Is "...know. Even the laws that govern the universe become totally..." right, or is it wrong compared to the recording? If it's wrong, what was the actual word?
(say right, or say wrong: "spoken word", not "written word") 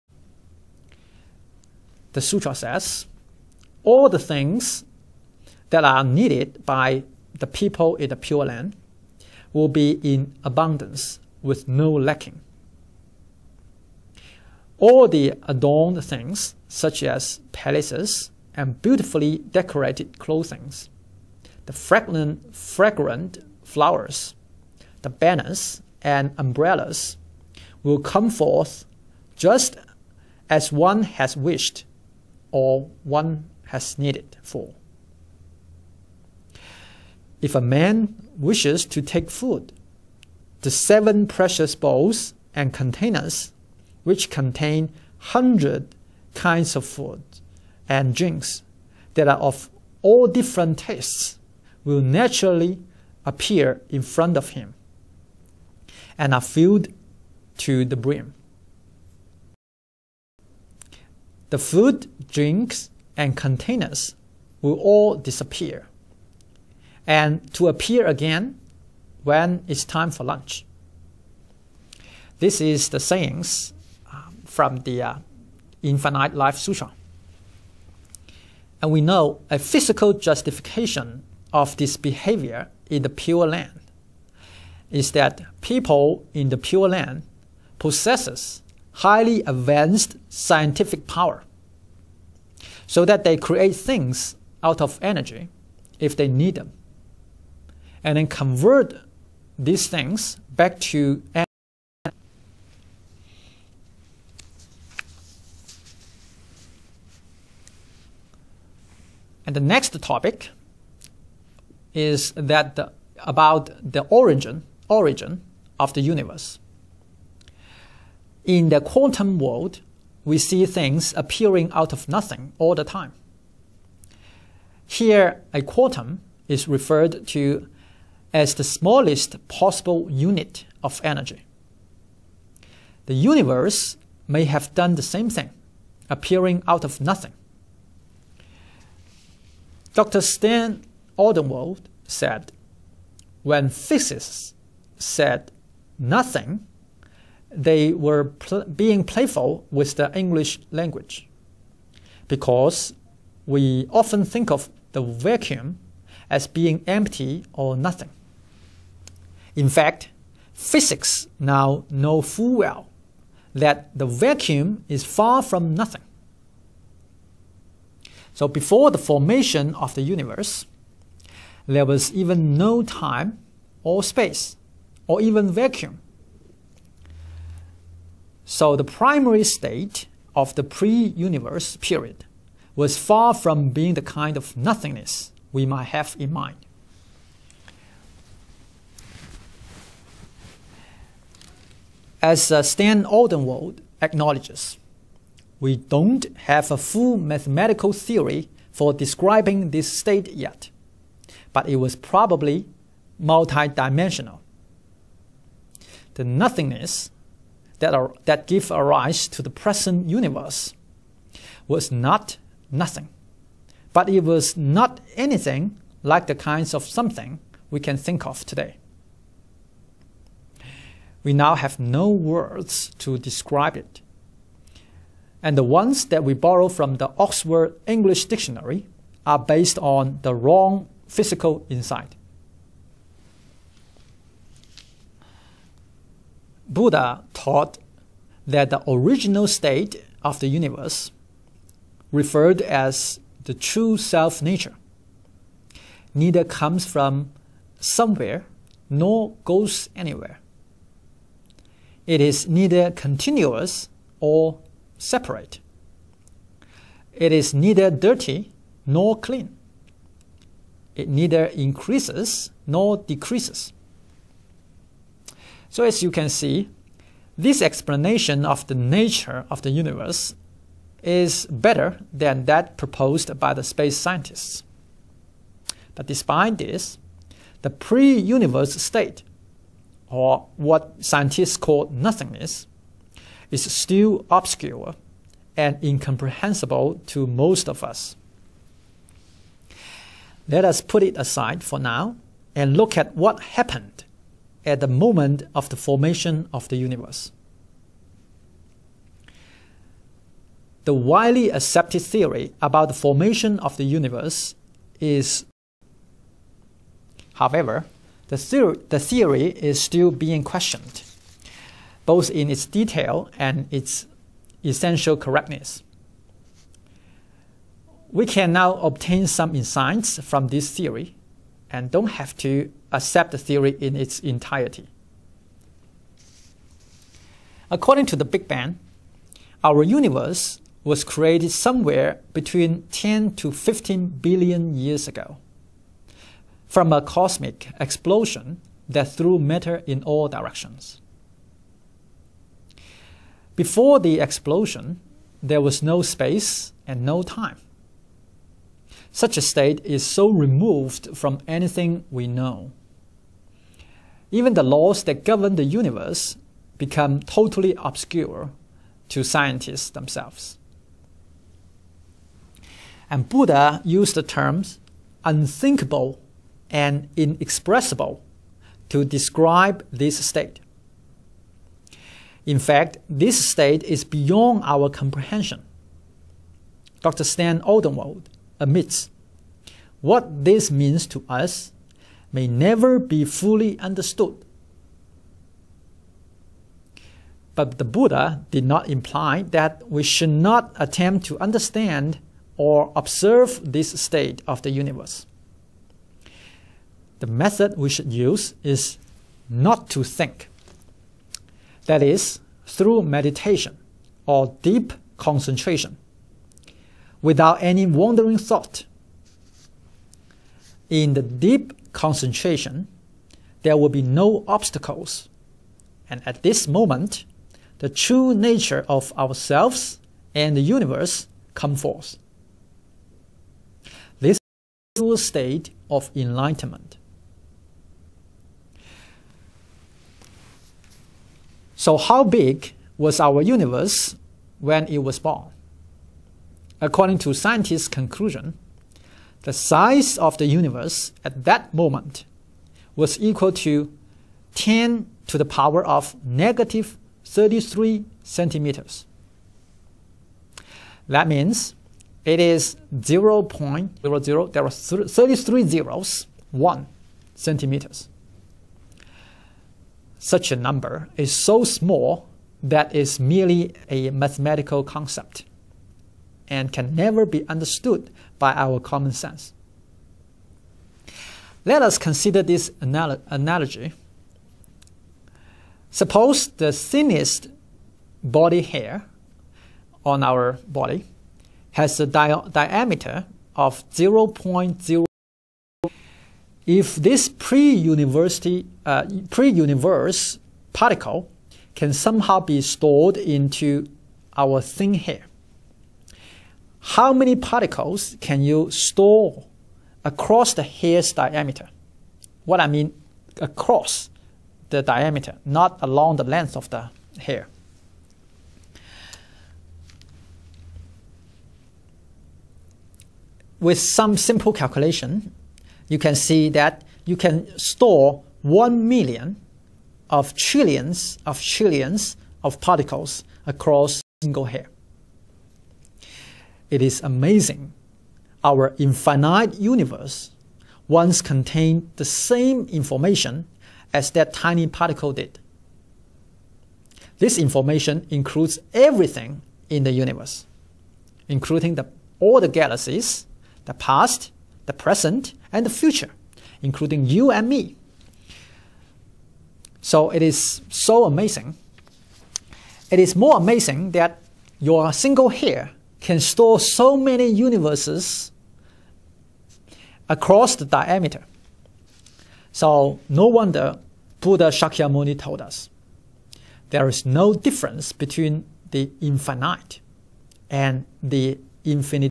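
right.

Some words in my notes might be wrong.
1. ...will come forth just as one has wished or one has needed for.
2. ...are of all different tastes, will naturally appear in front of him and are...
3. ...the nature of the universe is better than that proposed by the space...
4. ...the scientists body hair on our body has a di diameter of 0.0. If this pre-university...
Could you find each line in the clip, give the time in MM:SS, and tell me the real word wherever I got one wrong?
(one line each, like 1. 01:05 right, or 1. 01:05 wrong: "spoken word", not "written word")
1. 00:27 right
2. 00:49 right
3. 04:28 right
4. 07:56 wrong: "thinnest", not "scientists".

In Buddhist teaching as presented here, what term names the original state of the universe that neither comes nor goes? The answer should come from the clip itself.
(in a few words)
true self nature.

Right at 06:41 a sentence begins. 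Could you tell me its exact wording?
That is, through meditation or deep concentration without any wandering thought.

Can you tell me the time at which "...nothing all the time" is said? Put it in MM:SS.
02:02.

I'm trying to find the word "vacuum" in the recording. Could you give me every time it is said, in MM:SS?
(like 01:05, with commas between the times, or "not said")
02:35, 02:44, 02:55.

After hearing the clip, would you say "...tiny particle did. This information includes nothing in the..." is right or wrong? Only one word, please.
wrong.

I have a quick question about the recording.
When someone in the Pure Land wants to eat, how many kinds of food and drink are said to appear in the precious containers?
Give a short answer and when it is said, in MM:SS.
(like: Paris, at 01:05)
100, at 00:45.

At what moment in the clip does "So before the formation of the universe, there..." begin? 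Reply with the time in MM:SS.
02:48.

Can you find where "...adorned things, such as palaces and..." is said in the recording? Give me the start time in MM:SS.
00:15.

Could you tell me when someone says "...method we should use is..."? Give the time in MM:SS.
06:37.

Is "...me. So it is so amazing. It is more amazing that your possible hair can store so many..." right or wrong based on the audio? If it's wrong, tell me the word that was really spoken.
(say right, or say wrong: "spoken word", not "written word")
wrong: "single", not "possible".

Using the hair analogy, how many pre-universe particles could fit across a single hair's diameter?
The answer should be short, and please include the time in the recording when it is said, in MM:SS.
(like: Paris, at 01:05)
1 million trillion trillion, at 08:38.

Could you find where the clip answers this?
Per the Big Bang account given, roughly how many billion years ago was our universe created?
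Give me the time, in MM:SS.
05:32.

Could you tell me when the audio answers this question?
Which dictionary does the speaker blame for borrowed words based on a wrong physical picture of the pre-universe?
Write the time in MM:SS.
03:47.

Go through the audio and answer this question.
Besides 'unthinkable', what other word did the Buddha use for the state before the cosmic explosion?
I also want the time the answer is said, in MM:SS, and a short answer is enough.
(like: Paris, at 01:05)
inexpressible, at 06:07.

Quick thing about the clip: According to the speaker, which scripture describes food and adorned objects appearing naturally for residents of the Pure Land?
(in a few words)
Infinite Life Sutra.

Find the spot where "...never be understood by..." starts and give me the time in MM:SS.
07:46.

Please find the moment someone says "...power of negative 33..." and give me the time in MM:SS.
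07:25.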